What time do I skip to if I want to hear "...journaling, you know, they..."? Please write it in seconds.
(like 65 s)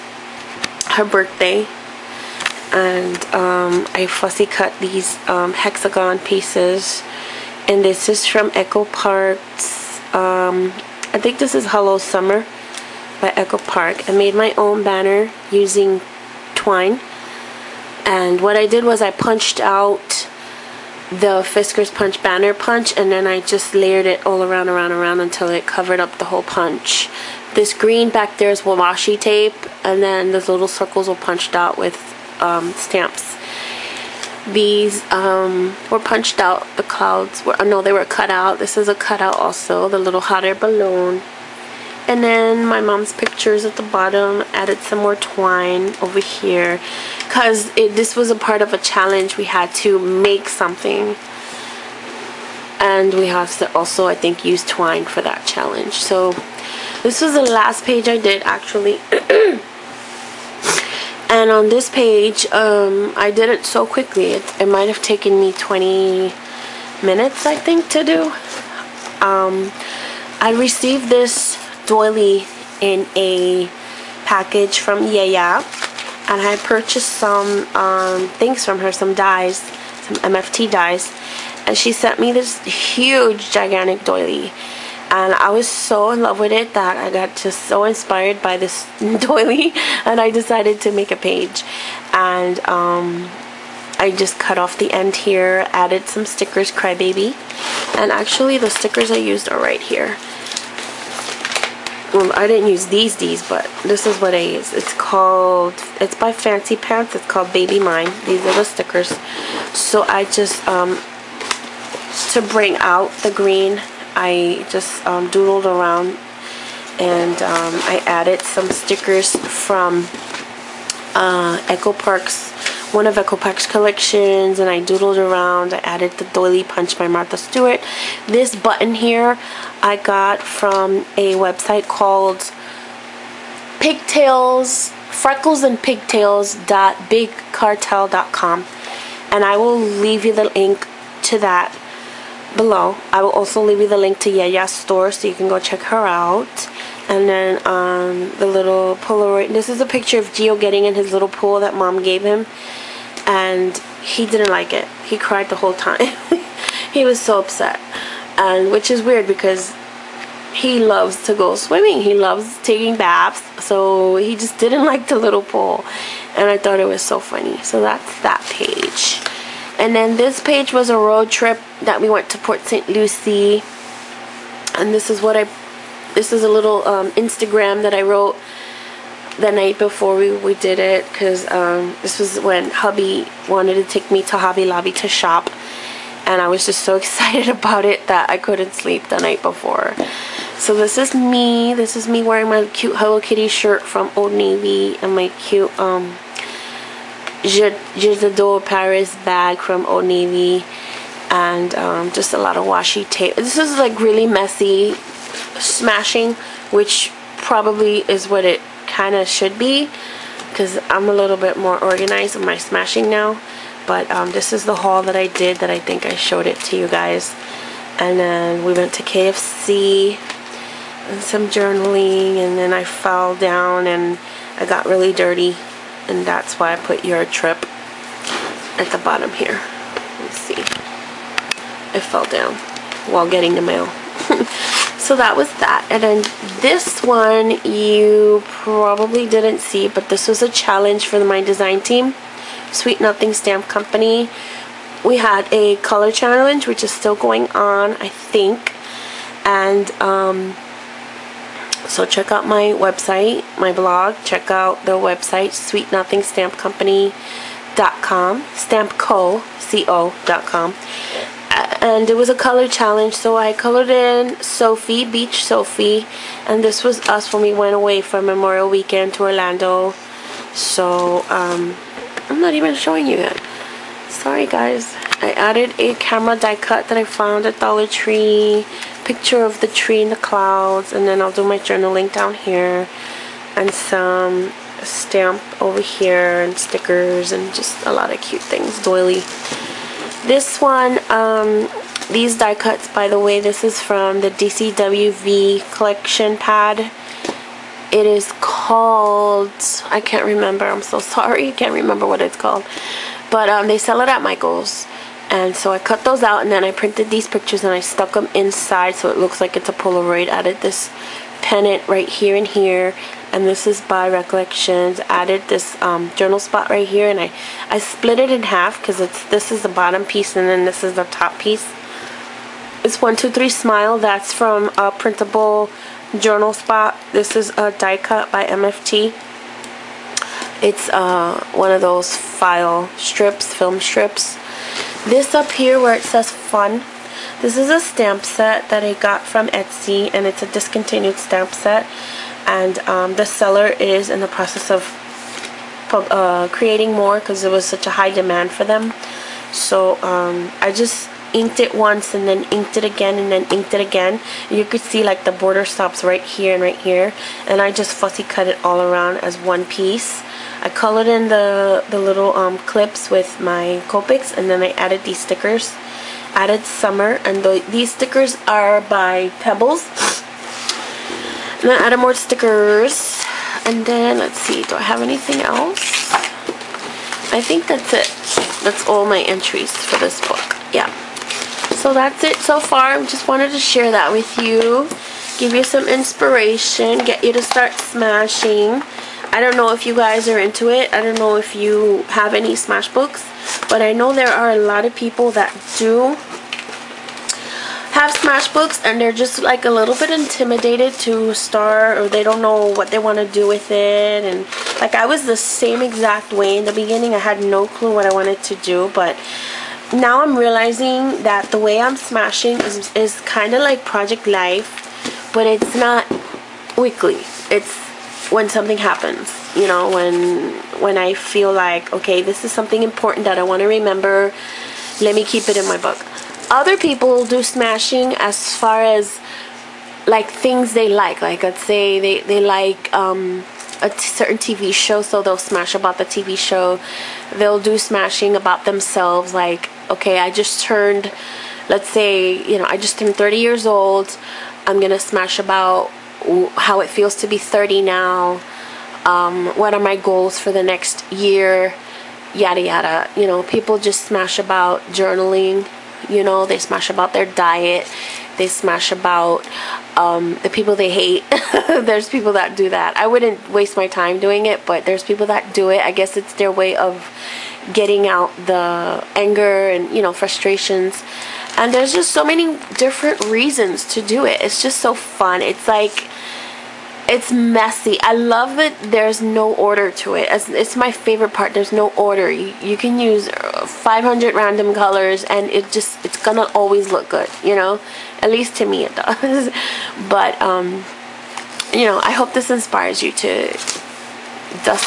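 454 s.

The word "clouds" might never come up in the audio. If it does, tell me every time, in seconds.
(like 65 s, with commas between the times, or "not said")
36 s, 280 s.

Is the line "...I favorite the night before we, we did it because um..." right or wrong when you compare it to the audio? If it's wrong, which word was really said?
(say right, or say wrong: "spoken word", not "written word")
wrong: "wrote", not "favorite".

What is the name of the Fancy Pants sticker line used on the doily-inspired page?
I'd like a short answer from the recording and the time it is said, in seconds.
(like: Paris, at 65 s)
Baby Mine, at 107 s.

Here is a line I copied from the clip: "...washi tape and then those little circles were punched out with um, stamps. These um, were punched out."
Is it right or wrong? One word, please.
right.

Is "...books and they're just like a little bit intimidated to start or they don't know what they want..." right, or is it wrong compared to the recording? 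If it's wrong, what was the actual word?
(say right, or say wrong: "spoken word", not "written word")
right.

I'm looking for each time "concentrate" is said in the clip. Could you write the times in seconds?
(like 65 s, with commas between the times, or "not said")
not said.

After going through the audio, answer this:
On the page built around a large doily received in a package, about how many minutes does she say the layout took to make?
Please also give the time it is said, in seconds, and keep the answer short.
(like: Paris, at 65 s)
20, at 65 s.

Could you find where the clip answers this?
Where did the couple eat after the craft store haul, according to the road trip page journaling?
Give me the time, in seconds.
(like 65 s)
219 s.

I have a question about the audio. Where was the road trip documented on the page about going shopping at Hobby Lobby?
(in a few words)
Port St. Lucie.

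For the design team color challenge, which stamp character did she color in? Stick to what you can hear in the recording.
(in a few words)
Beach Sophie.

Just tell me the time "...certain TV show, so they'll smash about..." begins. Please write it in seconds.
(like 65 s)
433 s.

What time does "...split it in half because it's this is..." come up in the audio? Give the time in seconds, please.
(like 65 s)
317 s.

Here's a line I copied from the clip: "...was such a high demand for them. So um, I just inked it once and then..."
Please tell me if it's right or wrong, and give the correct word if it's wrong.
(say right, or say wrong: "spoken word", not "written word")
right.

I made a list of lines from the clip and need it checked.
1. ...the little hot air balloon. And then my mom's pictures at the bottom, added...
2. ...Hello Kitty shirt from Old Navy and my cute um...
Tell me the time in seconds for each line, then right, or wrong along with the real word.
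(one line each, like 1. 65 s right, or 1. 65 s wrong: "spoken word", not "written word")
1. 39 s right
2. 192 s right.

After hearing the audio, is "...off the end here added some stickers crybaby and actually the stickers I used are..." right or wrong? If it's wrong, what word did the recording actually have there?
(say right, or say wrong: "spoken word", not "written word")
right.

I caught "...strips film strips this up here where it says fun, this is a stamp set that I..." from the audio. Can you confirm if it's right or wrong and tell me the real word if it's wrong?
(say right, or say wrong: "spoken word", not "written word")
right.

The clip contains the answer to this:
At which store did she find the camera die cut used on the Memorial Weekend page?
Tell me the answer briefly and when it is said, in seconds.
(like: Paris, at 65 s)
Dollar Tree, at 277 s.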